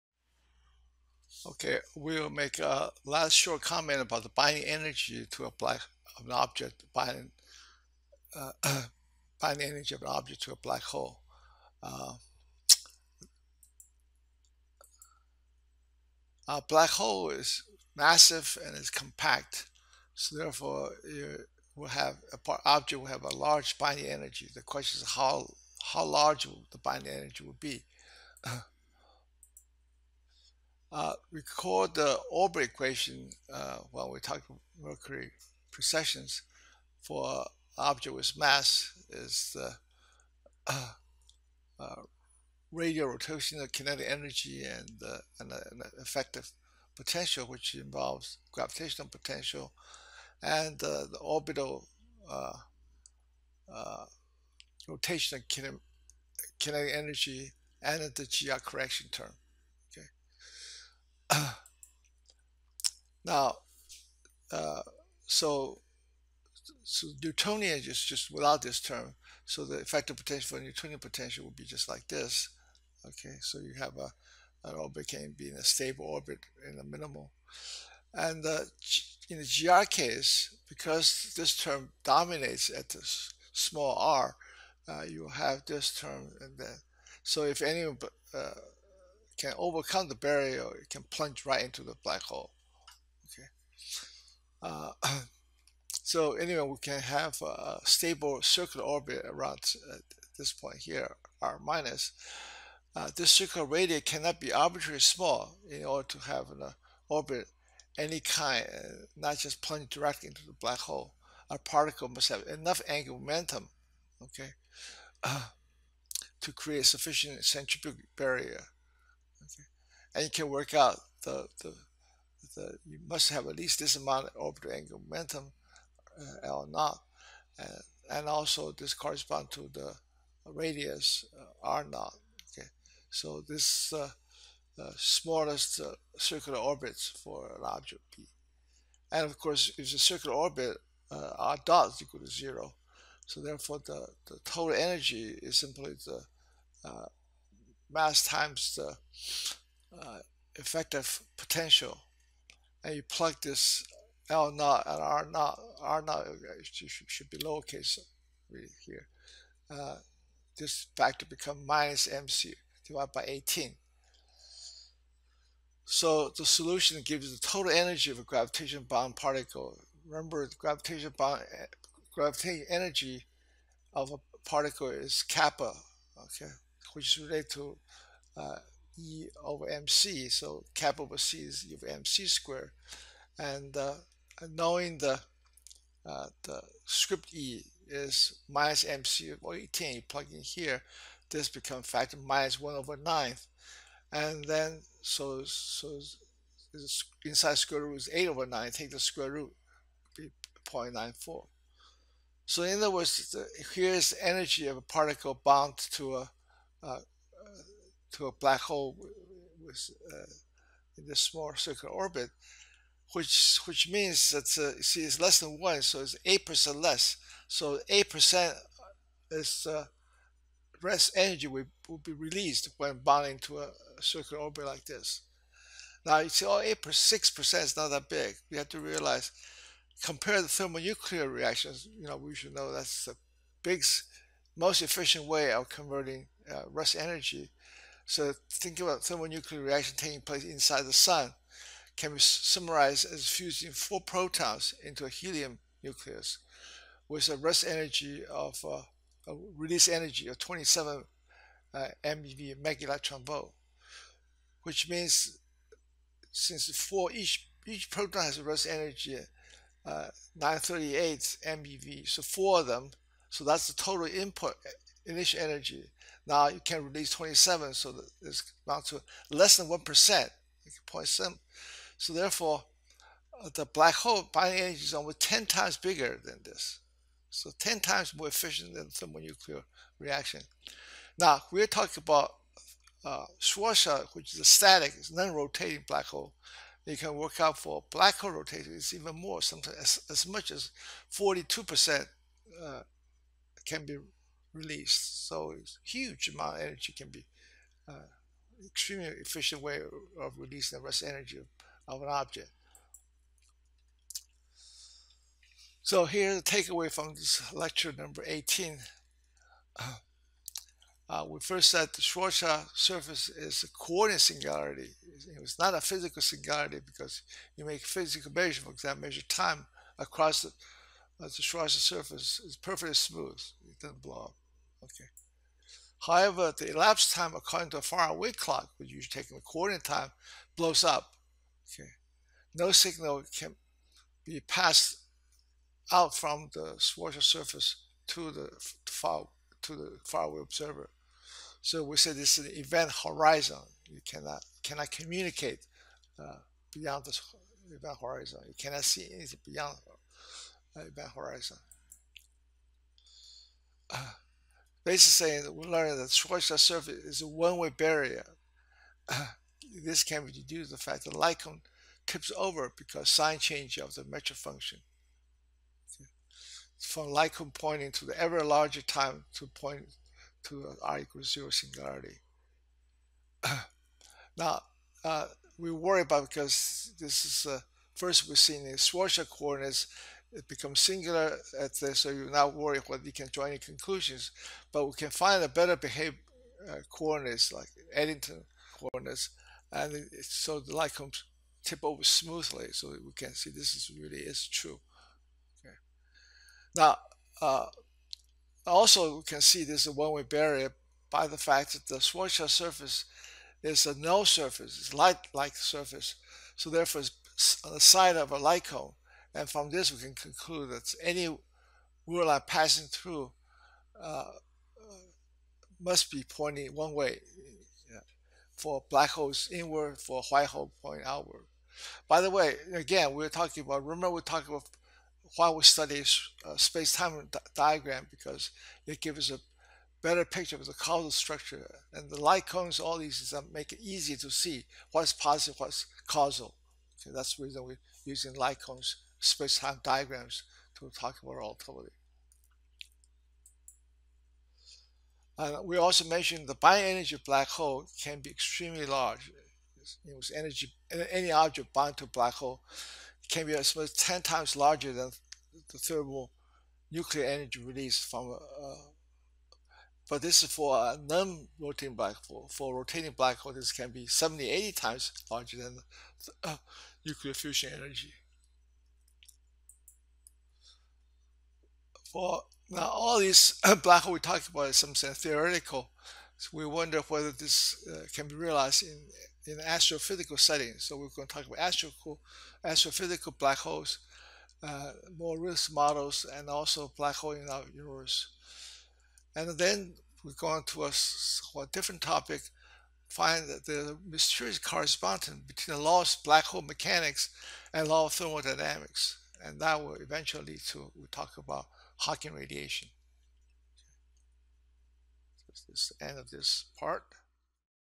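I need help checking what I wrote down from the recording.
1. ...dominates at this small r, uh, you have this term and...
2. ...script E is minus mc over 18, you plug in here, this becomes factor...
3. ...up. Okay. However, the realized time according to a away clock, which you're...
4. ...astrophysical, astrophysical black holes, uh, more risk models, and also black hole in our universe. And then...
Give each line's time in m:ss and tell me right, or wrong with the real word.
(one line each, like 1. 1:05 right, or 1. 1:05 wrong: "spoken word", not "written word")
1. 1:22 right
2. 3:06 right
3. 5:24 wrong: "elapsed", not "realized"
4. 8:01 right.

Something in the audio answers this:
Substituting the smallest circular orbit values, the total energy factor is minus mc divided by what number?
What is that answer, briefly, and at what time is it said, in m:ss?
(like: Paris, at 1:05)
18, at 2:41.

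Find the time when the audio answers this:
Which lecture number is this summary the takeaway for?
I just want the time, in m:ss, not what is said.
5:07.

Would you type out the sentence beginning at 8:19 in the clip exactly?
And that will eventually lead to, we talk about Hawking radiation.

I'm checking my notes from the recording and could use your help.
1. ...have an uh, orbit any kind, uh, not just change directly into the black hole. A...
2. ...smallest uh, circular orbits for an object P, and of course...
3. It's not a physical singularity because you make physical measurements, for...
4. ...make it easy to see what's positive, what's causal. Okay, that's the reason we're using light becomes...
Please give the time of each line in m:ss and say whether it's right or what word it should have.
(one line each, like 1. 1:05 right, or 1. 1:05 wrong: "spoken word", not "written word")
1. 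1:46 wrong: "plunge", not "change"
2. 2:14 right
3. 5:15 right
4. 7:13 wrong: "cones", not "becomes".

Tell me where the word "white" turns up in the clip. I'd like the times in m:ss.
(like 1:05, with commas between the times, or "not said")
7:00.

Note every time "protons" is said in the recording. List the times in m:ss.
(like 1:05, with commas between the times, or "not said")
4:04, 4:17.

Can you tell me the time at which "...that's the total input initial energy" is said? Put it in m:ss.
4:23.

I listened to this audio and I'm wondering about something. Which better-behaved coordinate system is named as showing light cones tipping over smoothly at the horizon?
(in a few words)
Eddington coordinates.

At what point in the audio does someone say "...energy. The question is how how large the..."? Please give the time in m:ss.
0:24.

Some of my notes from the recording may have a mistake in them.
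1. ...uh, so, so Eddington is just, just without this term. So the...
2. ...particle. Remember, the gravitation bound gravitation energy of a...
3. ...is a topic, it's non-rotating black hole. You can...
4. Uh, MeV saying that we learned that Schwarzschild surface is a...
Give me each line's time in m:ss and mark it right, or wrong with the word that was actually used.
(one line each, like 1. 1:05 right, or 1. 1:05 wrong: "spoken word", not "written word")
1. 1:04 wrong: "Newtonian", not "Eddington"
2. 2:49 right
3. 4:44 wrong: "static", not "topic"
4. 5:53 wrong: "Basically", not "MeV".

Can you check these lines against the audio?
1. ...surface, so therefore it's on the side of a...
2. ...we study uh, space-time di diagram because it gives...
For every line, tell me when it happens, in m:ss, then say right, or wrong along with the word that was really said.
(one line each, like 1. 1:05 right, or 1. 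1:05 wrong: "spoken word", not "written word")
1. 6:45 right
2. 7:05 right.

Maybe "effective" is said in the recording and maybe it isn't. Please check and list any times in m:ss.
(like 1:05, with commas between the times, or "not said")
0:45, 1:09, 2:30.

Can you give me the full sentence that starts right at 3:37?
So eight percent is uh, rest energy will, will be released when bonding to a circular orbit like this.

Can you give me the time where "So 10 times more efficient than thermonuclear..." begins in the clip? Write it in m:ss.
4:37.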